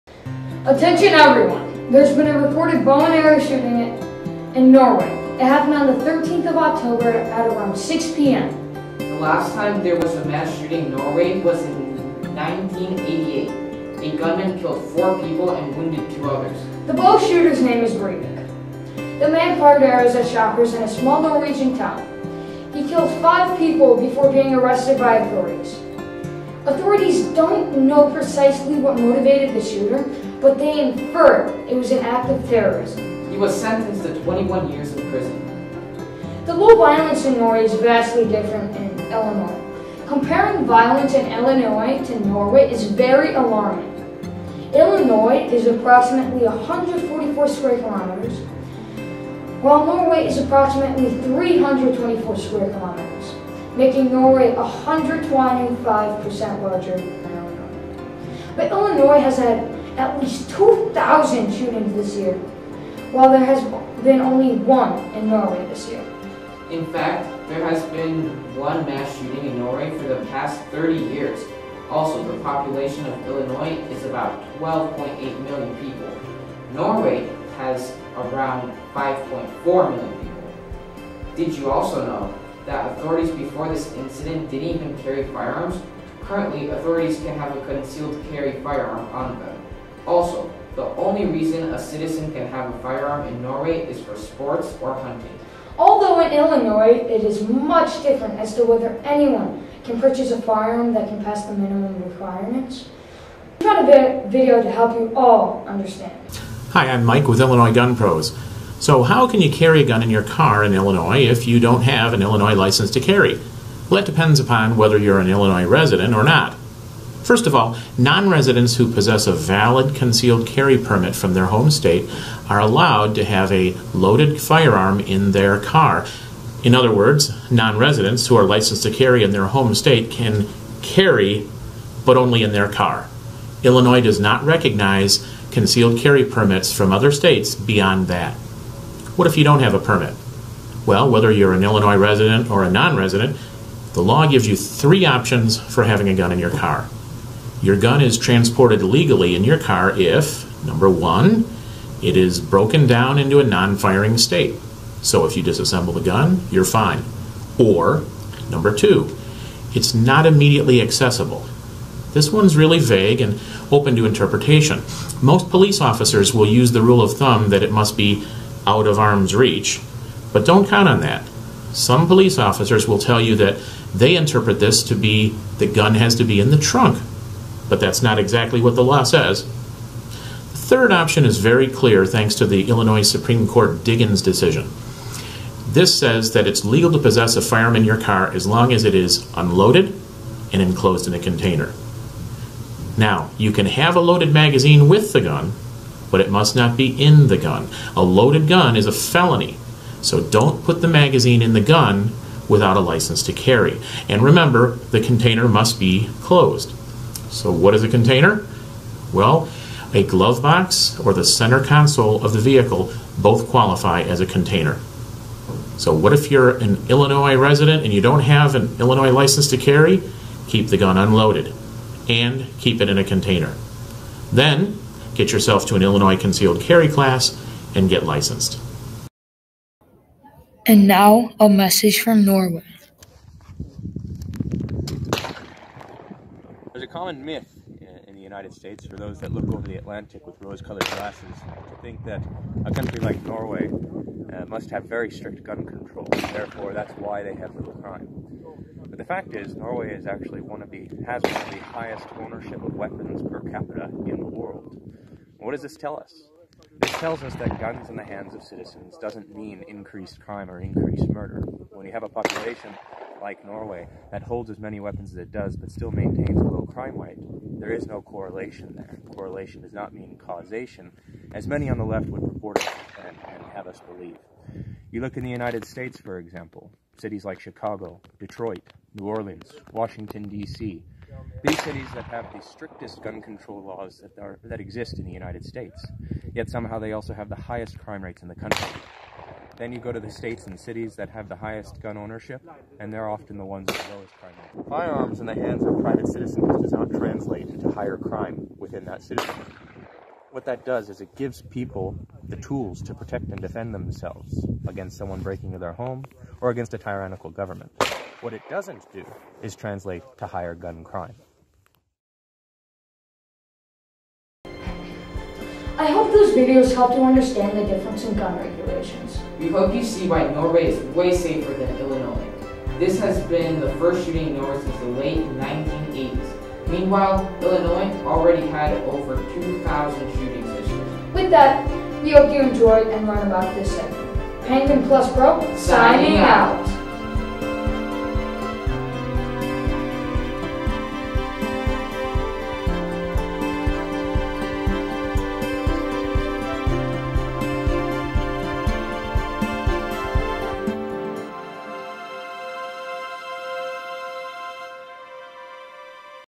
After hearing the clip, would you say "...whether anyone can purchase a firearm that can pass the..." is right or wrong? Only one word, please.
right.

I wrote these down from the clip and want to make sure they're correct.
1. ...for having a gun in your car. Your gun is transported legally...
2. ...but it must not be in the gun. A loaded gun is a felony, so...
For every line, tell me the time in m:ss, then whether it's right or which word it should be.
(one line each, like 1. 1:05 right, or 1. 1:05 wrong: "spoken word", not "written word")
1. 2:25 right
2. 3:16 right.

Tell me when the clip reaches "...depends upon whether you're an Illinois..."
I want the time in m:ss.
1:54.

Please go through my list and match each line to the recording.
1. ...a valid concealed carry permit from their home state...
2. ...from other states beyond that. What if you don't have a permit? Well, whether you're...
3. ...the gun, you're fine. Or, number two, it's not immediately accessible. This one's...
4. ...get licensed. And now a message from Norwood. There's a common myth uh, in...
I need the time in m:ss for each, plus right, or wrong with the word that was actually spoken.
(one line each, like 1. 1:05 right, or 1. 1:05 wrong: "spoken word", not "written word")
1. 1:59 right
2. 2:16 right
3. 2:35 right
4. 3:47 right.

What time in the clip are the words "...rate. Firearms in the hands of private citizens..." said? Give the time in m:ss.
4:54.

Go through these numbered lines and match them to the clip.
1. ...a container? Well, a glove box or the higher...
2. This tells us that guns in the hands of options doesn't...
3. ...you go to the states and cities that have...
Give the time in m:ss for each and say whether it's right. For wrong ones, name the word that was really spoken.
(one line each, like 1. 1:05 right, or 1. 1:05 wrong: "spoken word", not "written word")
1. 3:27 wrong: "center", not "higher"
2. 4:16 wrong: "citizens", not "options"
3. 4:49 right.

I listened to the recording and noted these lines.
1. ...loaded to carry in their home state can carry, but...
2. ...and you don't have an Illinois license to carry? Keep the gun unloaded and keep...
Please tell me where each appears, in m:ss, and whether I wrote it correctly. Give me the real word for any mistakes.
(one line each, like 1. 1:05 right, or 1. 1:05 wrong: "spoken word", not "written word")
1. 2:08 wrong: "licensed", not "loaded"
2. 3:37 right.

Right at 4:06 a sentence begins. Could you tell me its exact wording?
Therefore, that's why they have little crime.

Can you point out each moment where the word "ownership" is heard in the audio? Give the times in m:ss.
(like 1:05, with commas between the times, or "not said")
4:12, 4:51.